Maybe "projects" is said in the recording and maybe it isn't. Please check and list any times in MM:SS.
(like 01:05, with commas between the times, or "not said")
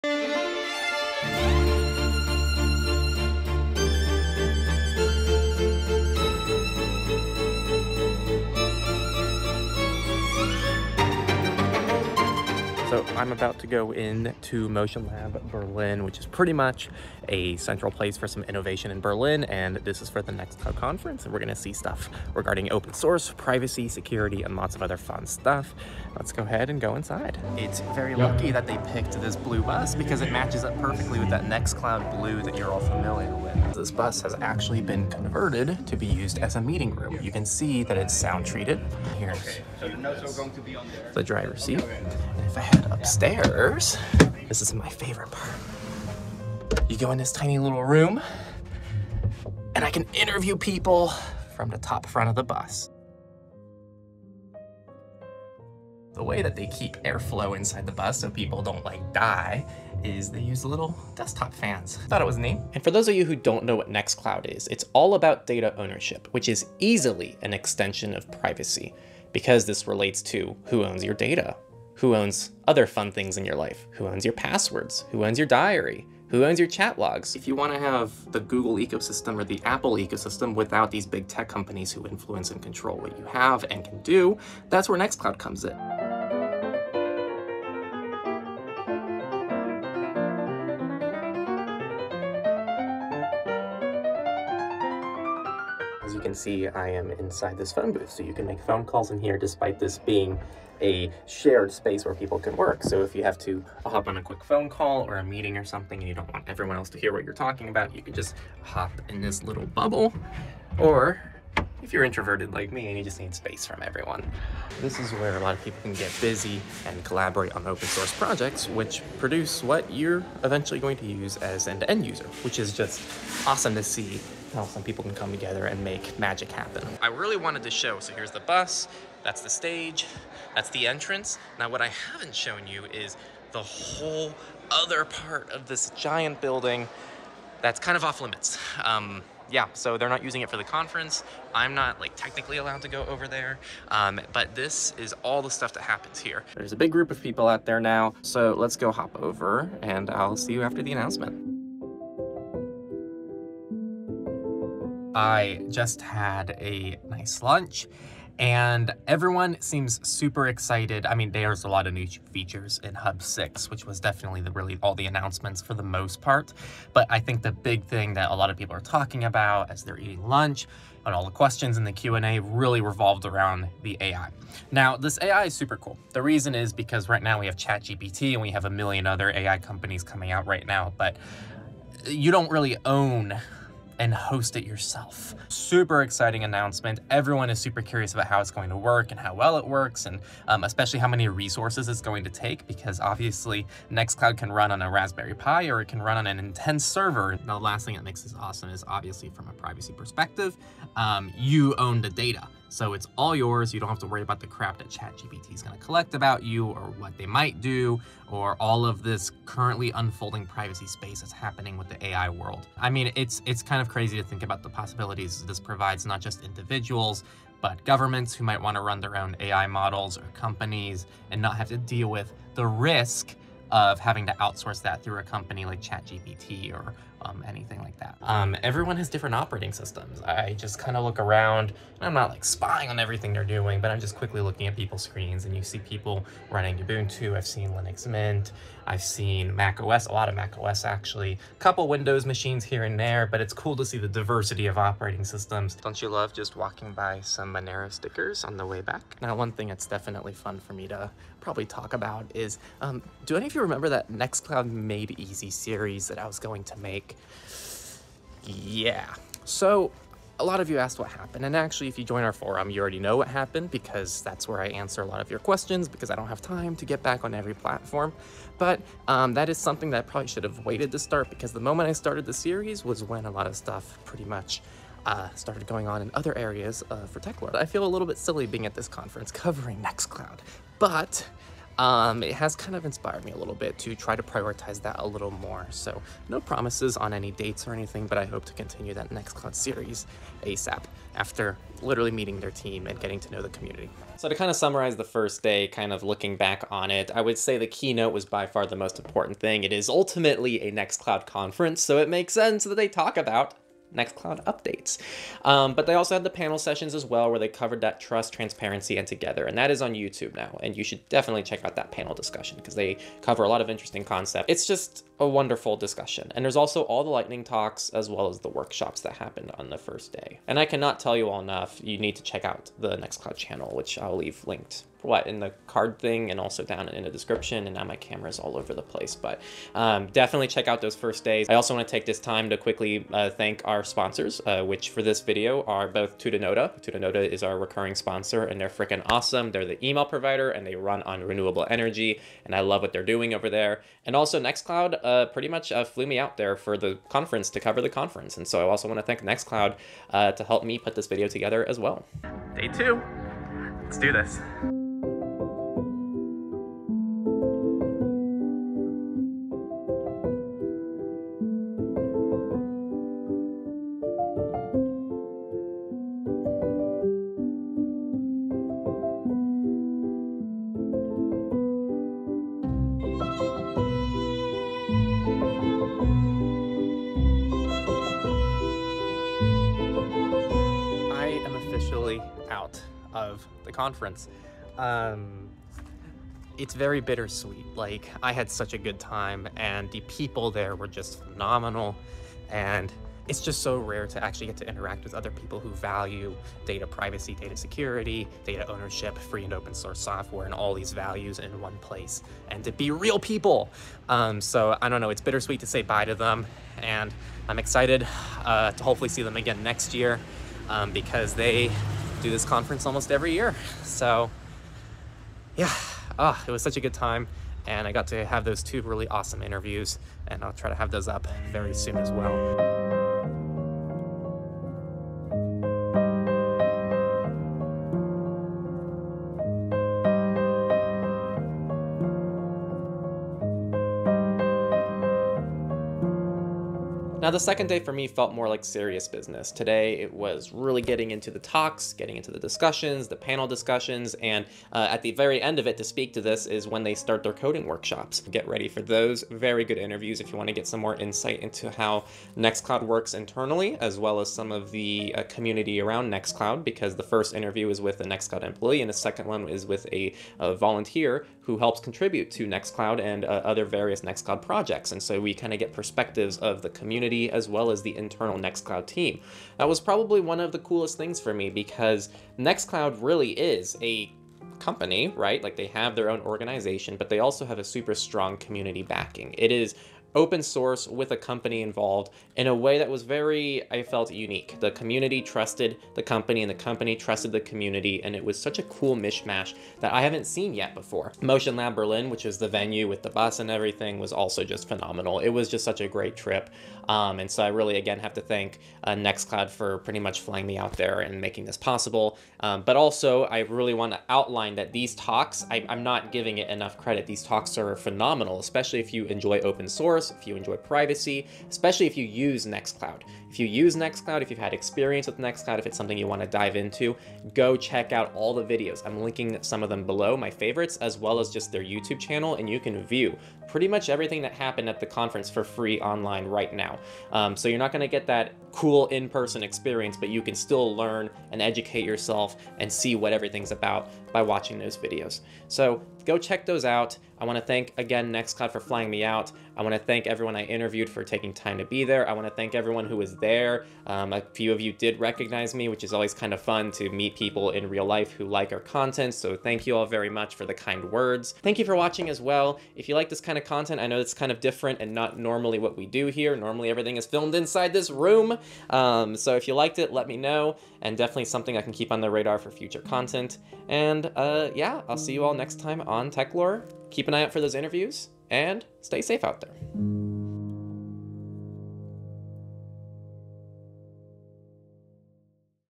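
01:58, 07:44.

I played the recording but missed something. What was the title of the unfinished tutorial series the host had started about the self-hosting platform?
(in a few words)
Nextcloud Made Easy.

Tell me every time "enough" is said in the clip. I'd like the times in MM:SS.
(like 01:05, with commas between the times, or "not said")
05:21, 08:26.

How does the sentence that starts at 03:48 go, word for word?
Um, everyone has different operating systems.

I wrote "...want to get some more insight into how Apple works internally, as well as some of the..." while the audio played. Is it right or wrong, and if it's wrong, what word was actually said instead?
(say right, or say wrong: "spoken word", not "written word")
wrong: "Nextcloud", not "Apple".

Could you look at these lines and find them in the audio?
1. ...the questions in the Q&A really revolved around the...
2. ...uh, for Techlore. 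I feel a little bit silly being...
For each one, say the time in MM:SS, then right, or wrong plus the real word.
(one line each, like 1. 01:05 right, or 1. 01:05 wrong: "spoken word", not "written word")
1. 02:51 right
2. 04:36 right.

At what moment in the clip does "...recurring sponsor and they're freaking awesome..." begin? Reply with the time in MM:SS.
05:37.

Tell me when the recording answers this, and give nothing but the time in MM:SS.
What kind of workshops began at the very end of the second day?
07:27.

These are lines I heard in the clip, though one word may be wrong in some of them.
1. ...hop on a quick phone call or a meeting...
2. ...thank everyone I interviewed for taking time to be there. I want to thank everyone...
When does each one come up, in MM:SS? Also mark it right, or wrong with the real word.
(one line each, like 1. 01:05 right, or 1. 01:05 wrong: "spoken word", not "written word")
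1. 01:43 right
2. 08:59 right.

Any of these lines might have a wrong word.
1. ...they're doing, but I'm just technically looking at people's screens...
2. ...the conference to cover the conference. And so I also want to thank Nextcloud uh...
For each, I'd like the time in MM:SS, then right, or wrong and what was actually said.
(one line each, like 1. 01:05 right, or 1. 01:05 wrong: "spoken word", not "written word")
1. 03:53 wrong: "quickly", not "technically"
2. 05:46 right.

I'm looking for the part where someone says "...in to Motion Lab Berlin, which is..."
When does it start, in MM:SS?
00:13.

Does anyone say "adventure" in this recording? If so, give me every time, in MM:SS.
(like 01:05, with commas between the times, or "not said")
not said.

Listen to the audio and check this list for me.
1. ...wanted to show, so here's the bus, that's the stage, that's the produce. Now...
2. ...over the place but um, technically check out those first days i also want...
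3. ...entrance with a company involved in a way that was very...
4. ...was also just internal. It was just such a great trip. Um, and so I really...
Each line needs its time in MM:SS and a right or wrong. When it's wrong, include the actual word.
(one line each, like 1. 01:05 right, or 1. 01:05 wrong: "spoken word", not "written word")
1. 02:07 wrong: "entrance", not "produce"
2. 05:28 wrong: "definitely", not "technically"
3. 08:00 wrong: "source", not "entrance"
4. 08:13 wrong: "phenomenal", not "internal".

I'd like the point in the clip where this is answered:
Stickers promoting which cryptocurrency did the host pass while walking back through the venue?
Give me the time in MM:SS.
04:07.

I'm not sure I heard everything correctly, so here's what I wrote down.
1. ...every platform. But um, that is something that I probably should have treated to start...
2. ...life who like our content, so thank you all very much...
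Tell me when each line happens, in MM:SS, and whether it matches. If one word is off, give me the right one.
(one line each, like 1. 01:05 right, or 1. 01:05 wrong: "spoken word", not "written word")
1. 04:27 wrong: "waited", not "treated"
2. 09:07 right.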